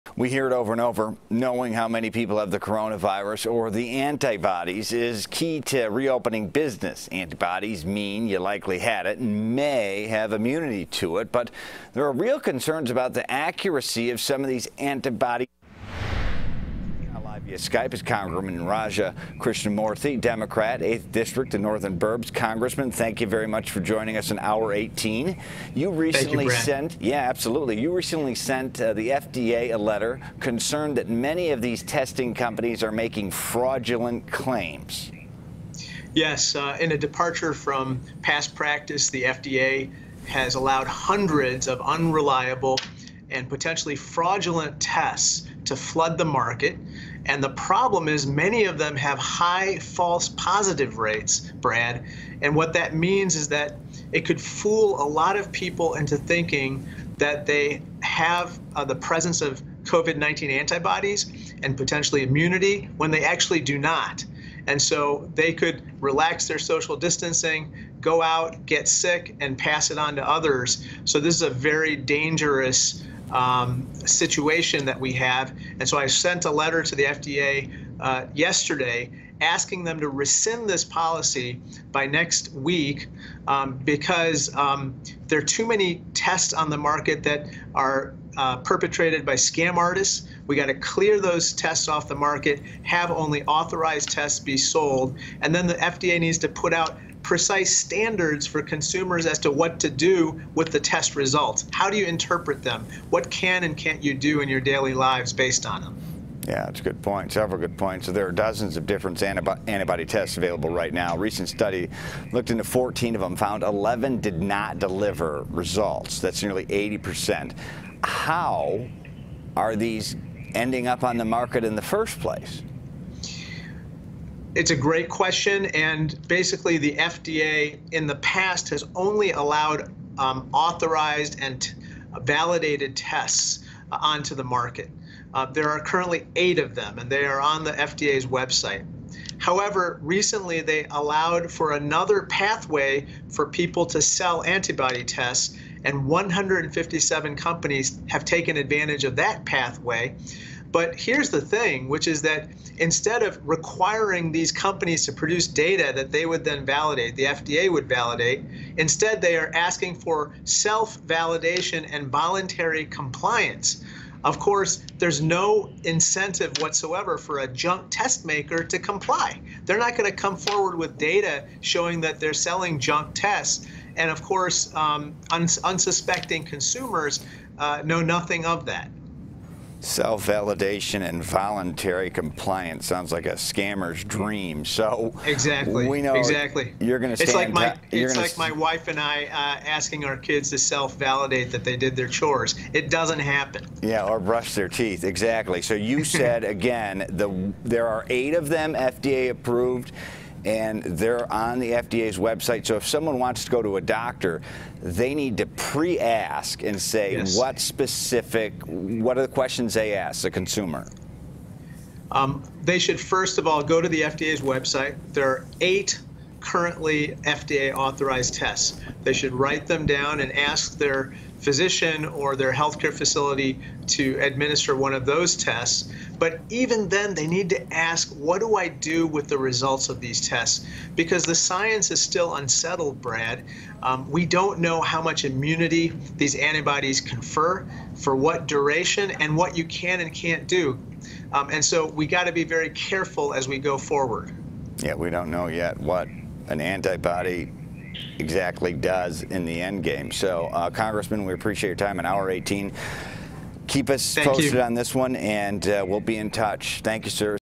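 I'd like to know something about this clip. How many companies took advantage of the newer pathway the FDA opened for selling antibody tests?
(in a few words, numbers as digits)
157.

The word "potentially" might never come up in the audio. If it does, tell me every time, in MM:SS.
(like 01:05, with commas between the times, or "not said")
00:43, 01:01.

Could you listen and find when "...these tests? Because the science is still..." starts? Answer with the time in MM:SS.
03:50.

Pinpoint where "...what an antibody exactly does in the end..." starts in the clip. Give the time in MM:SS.
04:05.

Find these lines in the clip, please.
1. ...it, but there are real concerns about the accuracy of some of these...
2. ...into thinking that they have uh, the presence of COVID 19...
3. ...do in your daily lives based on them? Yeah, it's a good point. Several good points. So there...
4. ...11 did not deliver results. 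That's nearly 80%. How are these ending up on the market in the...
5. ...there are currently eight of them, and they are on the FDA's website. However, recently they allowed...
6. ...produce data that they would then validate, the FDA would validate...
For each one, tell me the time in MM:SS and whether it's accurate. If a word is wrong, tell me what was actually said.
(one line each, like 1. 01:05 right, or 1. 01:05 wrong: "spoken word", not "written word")
1. 00:11 right
2. 00:55 right
3. 01:44 right
4. 01:53 right
5. 02:15 right
6. 02:35 right.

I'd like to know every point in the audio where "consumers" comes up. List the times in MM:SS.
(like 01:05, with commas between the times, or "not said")
01:38, 02:56, 03:30.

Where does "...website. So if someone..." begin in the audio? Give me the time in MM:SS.
03:22.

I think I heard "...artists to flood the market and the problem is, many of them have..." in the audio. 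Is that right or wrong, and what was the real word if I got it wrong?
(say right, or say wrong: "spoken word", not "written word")
wrong: "tests", not "artists".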